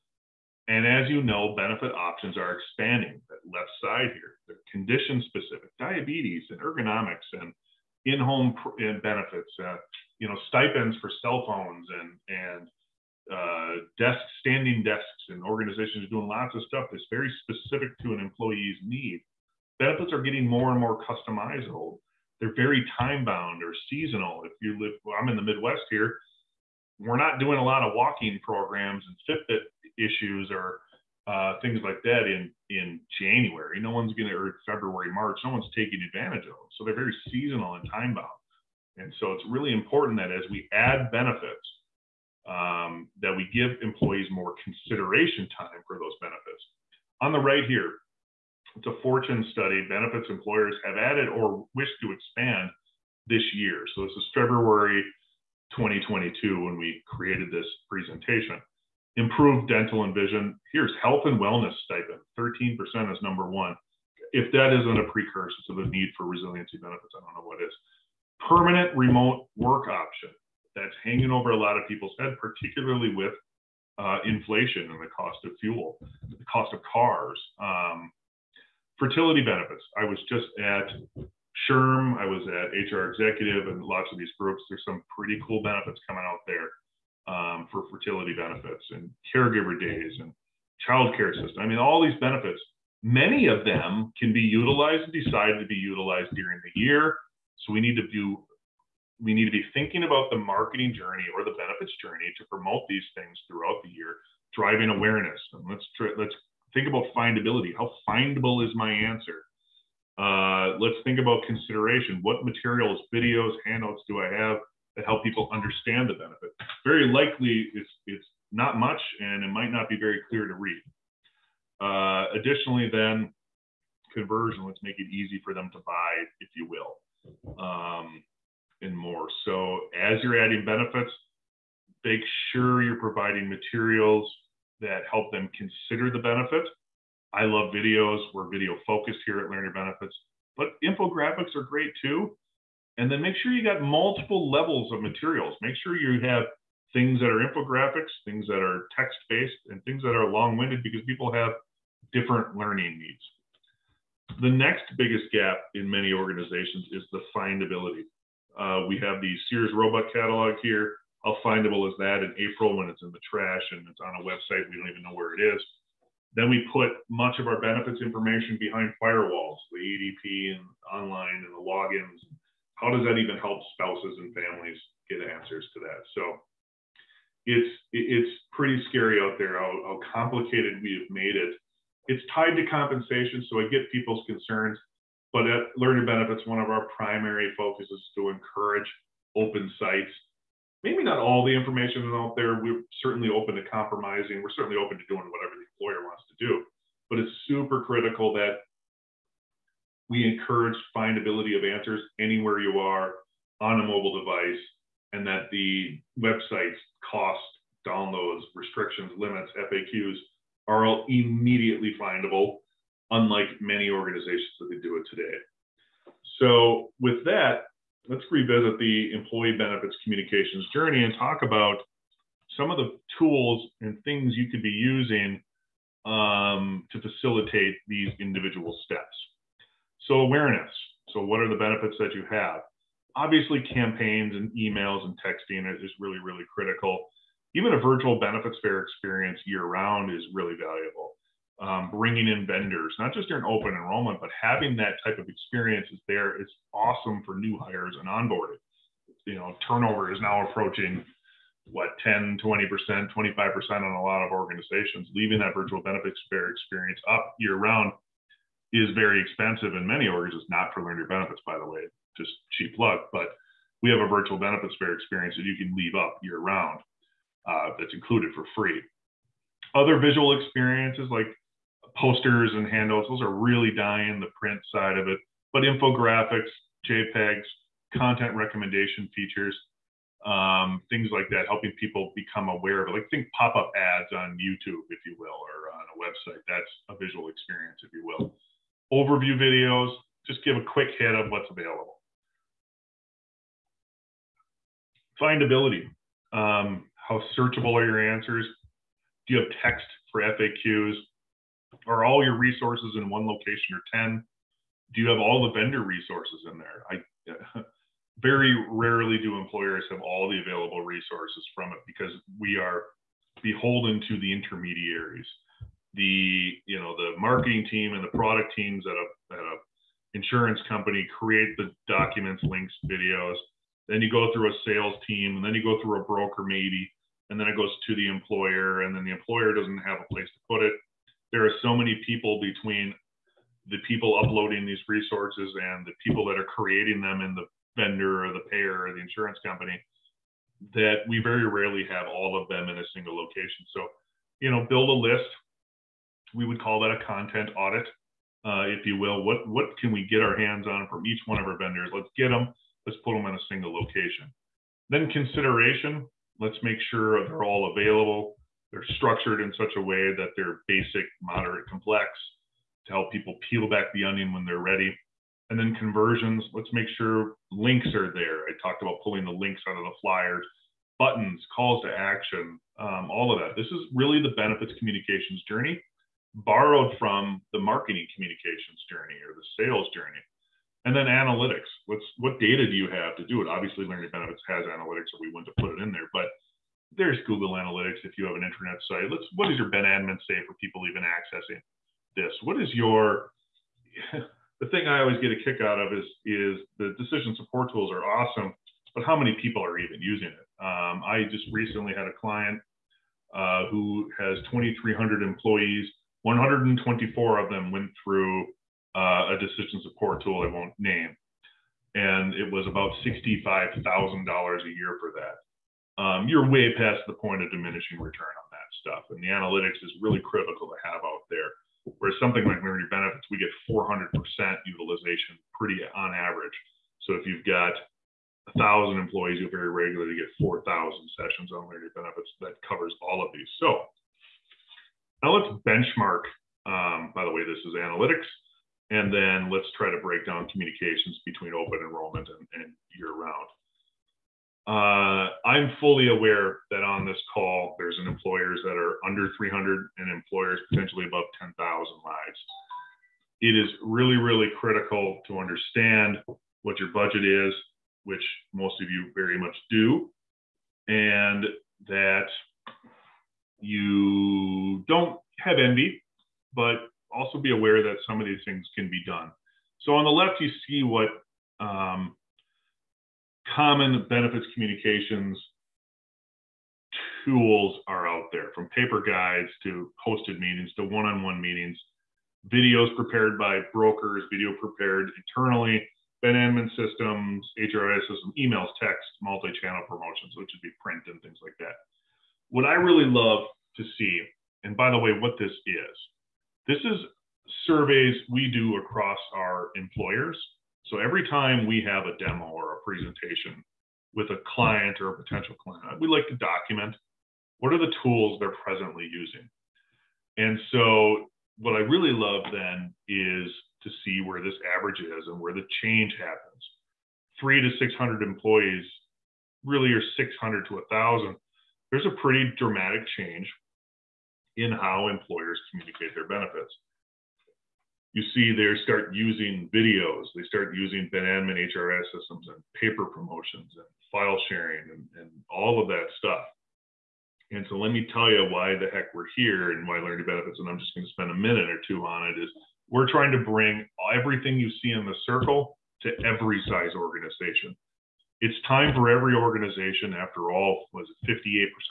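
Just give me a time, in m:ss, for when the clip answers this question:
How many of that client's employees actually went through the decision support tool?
6:46.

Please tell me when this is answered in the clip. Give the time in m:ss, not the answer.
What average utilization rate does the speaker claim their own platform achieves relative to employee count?
7:03.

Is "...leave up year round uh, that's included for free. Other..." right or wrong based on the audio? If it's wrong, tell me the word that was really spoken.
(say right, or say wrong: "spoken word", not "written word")
right.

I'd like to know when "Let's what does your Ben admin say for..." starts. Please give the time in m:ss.
6:29.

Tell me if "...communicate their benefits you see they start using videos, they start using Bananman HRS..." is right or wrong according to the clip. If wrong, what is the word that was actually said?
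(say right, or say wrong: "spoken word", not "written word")
right.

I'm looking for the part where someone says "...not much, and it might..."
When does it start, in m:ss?
1:58.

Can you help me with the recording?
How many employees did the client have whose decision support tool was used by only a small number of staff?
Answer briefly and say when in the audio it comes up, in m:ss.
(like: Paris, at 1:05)
2,300, at 6:44.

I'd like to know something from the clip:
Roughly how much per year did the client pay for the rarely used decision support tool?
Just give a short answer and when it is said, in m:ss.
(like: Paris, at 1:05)
$65,000, at 6:53.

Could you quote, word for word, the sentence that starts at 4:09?
You know, turnover is now approaching what 10, 20%, 25% on a lot of organizations.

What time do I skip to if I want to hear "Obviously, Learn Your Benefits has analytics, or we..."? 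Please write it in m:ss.
6:23.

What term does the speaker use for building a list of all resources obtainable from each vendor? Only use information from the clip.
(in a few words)
content audit.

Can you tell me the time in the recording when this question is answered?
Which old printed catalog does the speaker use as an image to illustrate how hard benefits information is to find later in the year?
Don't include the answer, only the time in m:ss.
2:39.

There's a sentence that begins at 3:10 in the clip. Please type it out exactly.
Maybe not all the information is out there.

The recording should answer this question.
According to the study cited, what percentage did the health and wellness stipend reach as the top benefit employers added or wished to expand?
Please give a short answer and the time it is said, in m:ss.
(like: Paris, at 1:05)
13%, at 1:02.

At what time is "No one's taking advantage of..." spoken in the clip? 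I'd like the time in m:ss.
0:35.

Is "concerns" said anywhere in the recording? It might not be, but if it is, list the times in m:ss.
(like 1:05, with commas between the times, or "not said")
3:04.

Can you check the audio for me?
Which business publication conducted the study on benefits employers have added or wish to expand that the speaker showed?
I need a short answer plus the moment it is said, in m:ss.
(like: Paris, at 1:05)
Fortune, at 0:49.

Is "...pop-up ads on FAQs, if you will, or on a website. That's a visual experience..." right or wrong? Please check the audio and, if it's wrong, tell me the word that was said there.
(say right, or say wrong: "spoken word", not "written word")
wrong: "YouTube", not "FAQs".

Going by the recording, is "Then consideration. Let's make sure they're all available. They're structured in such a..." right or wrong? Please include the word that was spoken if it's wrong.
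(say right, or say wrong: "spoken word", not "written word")
right.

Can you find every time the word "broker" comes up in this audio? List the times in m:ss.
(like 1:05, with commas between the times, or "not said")
5:26, 8:03.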